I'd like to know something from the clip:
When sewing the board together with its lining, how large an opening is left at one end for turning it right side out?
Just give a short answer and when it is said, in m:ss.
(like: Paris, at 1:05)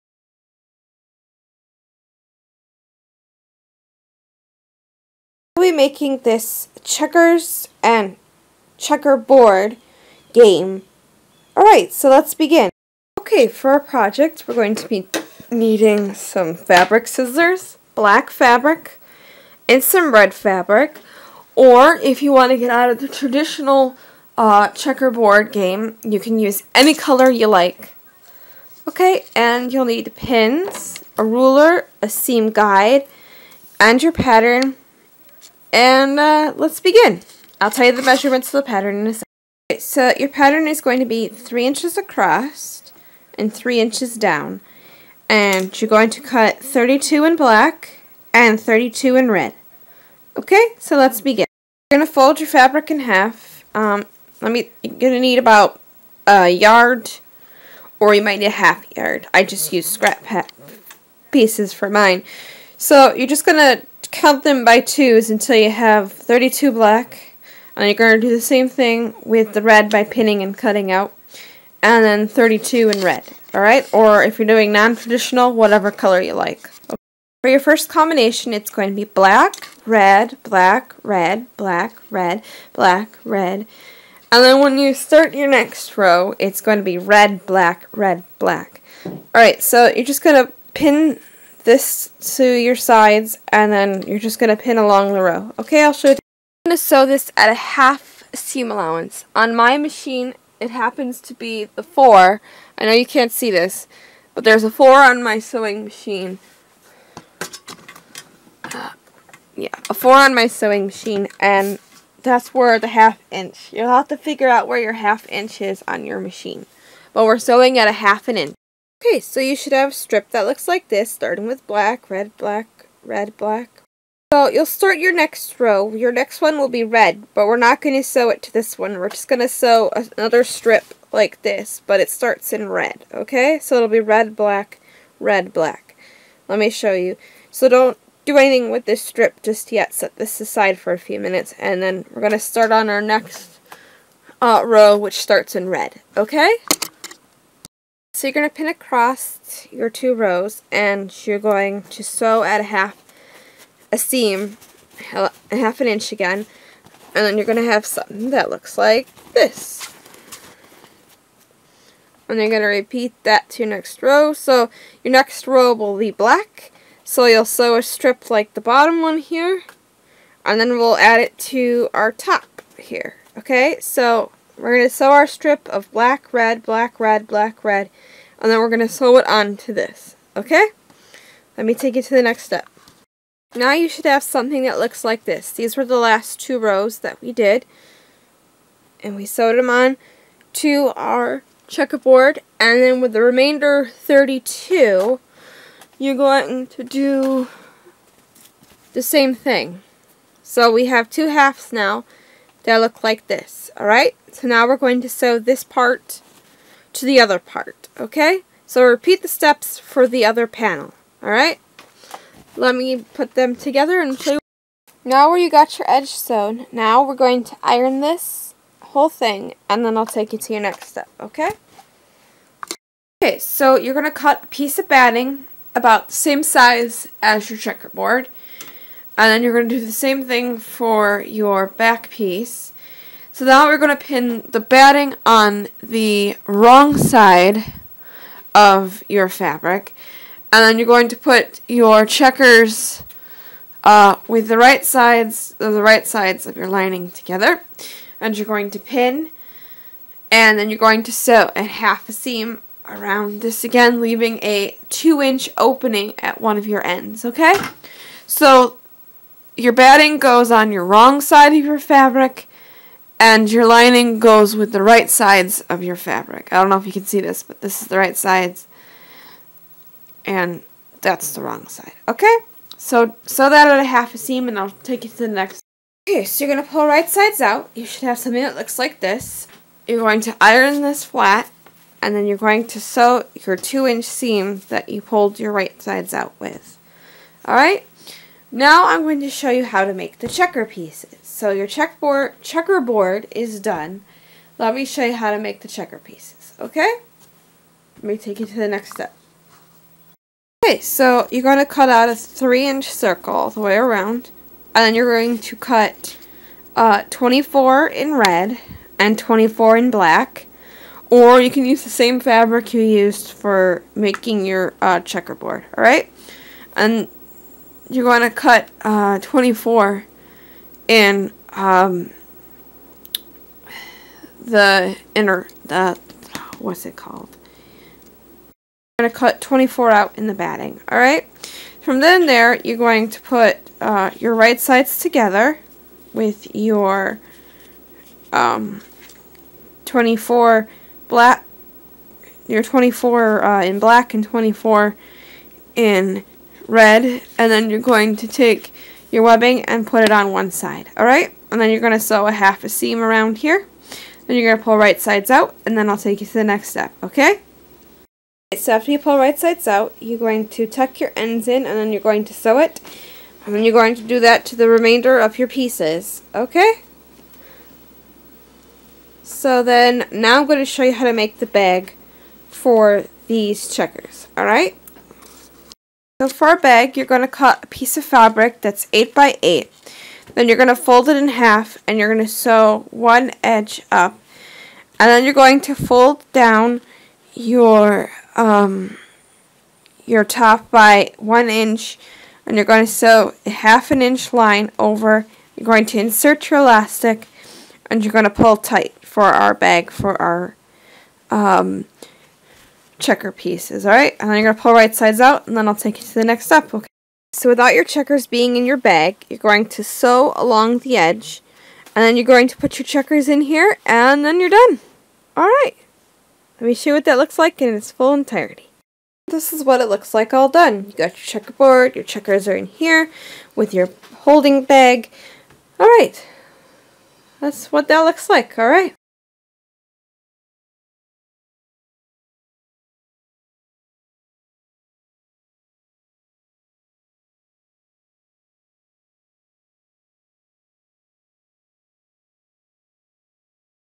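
2 inches, at 4:14.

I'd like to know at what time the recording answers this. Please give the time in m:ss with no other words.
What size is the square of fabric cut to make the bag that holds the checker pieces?
6:18.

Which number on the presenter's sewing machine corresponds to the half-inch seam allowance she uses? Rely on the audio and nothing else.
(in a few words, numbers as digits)
4.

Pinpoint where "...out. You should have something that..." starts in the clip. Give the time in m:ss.
4:37.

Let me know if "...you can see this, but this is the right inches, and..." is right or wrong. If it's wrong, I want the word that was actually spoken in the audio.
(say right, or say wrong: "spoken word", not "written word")
wrong: "sides", not "inches".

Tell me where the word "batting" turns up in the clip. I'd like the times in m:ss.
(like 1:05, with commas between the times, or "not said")
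3:44, 3:54, 4:19, 5:30.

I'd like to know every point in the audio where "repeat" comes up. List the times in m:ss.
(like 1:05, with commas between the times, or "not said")
2:42, 3:28.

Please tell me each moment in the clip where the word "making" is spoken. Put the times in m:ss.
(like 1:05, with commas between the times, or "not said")
0:05, 5:13.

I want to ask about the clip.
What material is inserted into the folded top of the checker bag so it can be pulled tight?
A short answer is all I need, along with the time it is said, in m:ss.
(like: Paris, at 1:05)
elastic, at 6:36.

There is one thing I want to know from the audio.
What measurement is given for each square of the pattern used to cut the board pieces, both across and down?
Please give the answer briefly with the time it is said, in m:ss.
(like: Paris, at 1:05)
3 inches, at 0:41.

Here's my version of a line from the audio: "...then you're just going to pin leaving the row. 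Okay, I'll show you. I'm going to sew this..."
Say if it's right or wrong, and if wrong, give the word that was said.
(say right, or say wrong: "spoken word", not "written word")
wrong: "along", not "leaving".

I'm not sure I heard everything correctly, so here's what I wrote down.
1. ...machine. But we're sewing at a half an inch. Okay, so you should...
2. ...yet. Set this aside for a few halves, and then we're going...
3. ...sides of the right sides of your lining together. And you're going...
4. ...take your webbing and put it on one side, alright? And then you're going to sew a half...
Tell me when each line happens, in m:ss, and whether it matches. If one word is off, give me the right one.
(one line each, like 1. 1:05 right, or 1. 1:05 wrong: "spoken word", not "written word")
1. 1:56 right
2. 2:19 wrong: "minutes", not "halves"
3. 4:04 right
4. 5:48 right.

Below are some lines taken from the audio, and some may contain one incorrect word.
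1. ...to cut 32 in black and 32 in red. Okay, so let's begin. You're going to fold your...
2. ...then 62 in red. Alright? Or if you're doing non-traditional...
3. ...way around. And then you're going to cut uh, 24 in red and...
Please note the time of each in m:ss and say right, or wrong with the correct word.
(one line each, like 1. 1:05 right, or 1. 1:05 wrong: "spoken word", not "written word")
1. 0:46 right
2. 1:12 wrong: "32", not "62"
3. 5:03 right.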